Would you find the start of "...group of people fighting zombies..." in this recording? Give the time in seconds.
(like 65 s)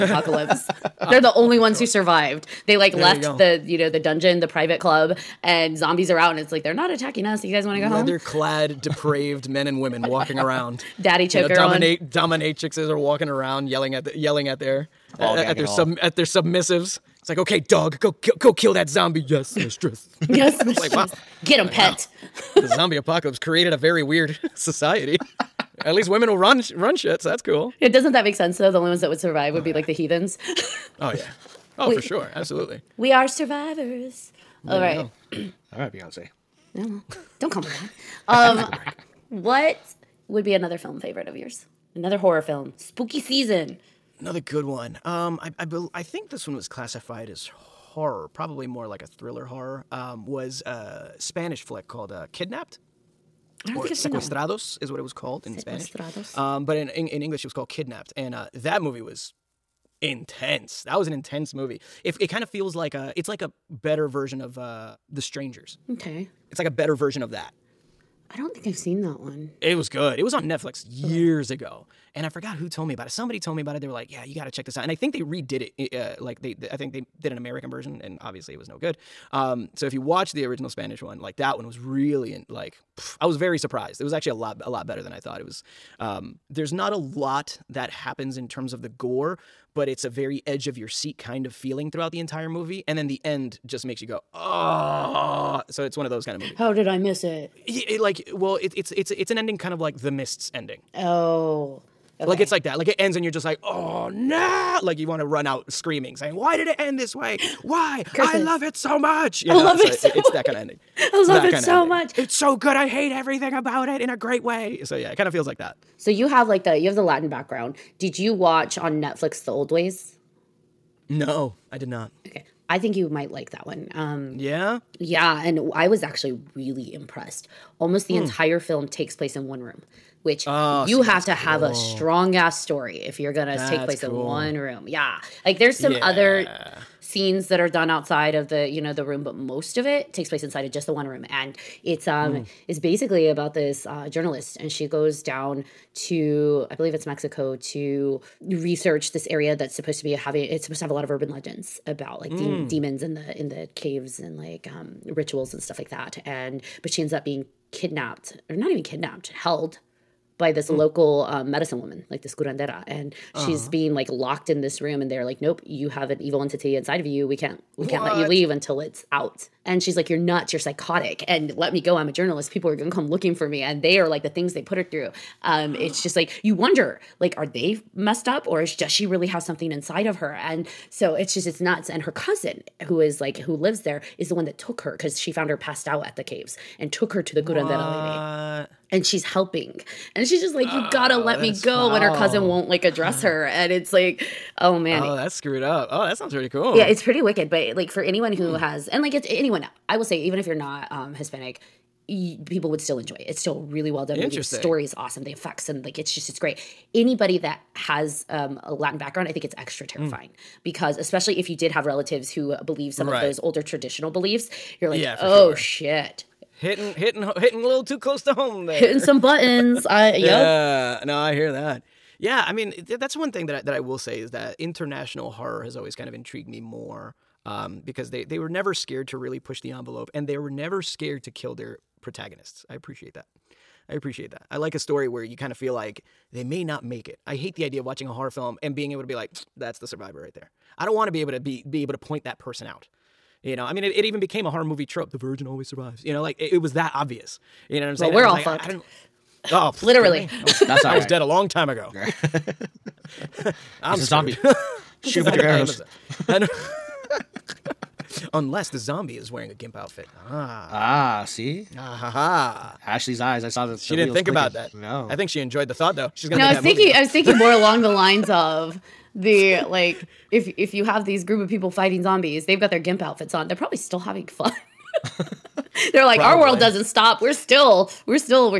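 271 s.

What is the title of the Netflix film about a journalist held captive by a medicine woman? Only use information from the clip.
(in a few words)
The Old Ways.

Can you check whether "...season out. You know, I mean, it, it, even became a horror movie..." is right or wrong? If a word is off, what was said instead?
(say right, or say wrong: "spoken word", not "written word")
wrong: "person", not "season".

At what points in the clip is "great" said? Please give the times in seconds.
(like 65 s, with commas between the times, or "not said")
114 s, 206 s.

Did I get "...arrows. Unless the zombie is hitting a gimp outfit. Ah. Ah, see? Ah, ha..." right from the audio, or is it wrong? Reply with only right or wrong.
wrong.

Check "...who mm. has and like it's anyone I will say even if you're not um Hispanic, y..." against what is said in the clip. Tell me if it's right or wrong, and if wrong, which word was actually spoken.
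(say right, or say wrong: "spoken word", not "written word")
right.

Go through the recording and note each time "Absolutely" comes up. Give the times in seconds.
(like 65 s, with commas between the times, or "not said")
32 s.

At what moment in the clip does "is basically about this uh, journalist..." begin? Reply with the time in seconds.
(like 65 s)
142 s.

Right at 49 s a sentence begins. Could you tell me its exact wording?
Um, was a Spanish flick called uh, Kidnapped.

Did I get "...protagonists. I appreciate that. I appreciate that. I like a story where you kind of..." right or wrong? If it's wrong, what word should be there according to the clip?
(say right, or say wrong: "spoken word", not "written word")
right.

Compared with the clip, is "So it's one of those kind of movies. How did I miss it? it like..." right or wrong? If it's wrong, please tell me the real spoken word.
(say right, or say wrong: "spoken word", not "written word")
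right.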